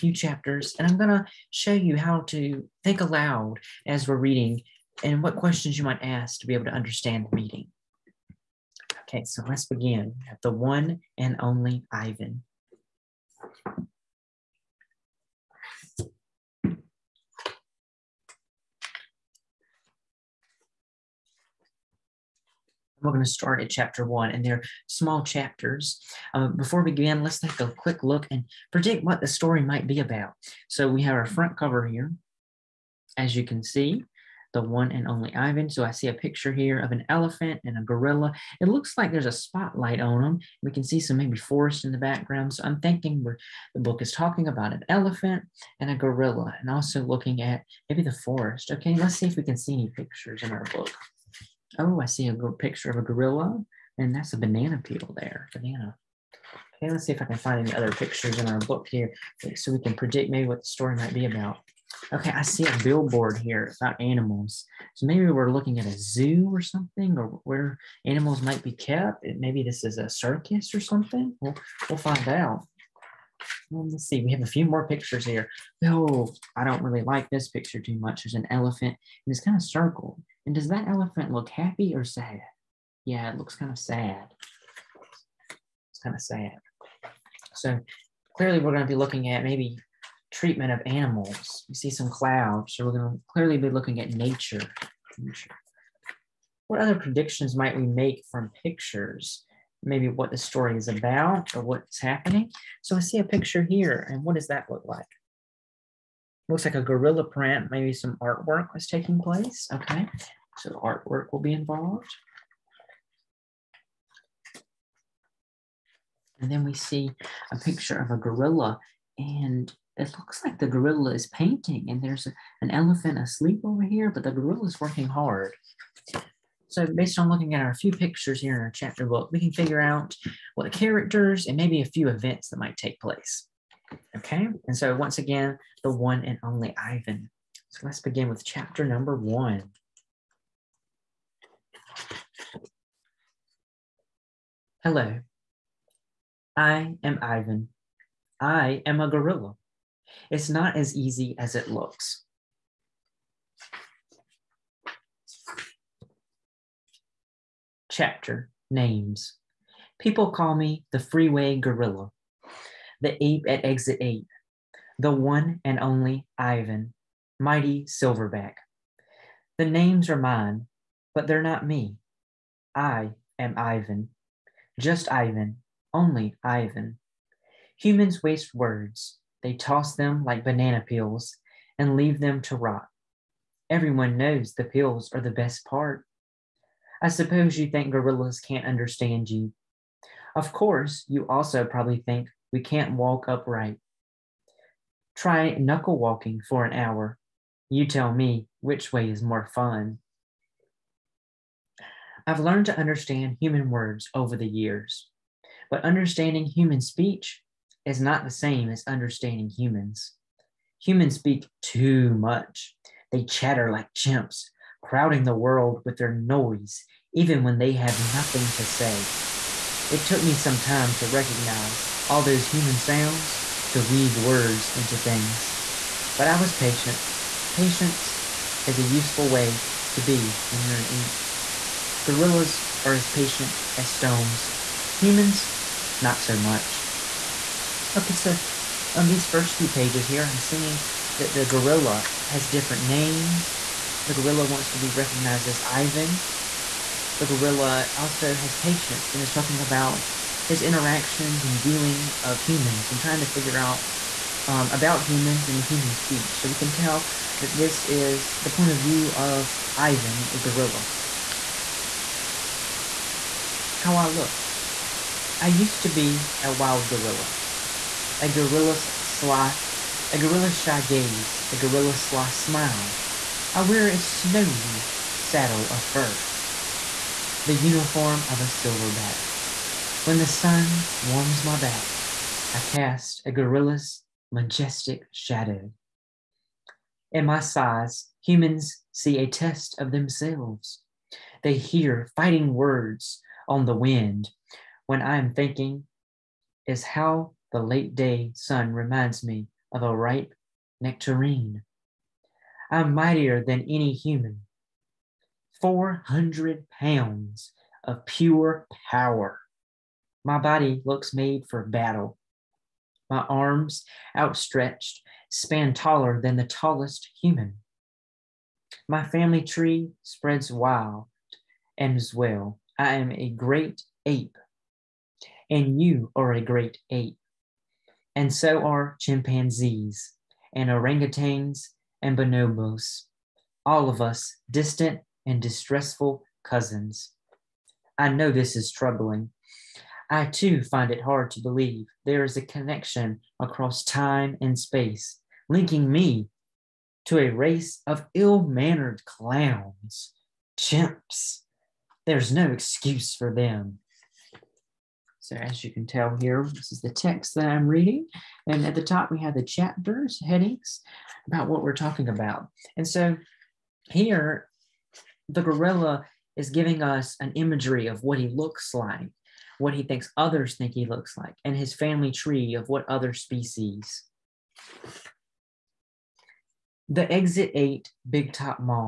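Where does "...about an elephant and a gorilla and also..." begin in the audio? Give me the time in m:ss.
0:44.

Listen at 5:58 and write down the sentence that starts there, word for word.
And at the top, we have the chapters, headings about what we're talking about.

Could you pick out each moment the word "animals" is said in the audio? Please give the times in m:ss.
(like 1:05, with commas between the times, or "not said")
1:04, 1:08, 1:30.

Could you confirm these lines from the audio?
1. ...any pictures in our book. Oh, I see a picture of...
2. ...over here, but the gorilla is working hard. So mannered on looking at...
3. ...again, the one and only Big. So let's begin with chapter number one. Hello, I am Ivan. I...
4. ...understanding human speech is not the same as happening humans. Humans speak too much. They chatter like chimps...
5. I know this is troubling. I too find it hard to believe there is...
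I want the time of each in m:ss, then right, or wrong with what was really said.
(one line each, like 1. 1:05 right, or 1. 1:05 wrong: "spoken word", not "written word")
1. 0:49 right
2. 2:03 wrong: "based", not "mannered"
3. 2:15 wrong: "Ivan", not "Big"
4. 3:25 wrong: "understanding", not "happening"
5. 5:37 right.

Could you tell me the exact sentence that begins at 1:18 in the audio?
There's an elephant, and it's kind of circled.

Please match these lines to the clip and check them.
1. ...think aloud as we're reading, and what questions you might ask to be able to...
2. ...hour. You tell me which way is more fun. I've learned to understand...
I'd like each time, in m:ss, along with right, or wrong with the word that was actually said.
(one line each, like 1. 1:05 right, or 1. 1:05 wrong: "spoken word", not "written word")
1. 0:02 right
2. 3:16 right.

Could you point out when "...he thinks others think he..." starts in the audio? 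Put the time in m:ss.
6:09.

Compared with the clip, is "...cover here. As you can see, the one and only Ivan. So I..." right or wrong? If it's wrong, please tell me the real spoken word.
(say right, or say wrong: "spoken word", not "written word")
right.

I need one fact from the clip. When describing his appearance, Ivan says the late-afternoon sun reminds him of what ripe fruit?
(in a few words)
nectarine.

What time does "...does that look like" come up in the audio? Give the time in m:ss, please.
1:44.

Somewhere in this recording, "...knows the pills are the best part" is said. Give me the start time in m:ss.
3:04.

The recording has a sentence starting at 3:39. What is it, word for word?
It took me some time to recognize all those human sounds, to weave words into things.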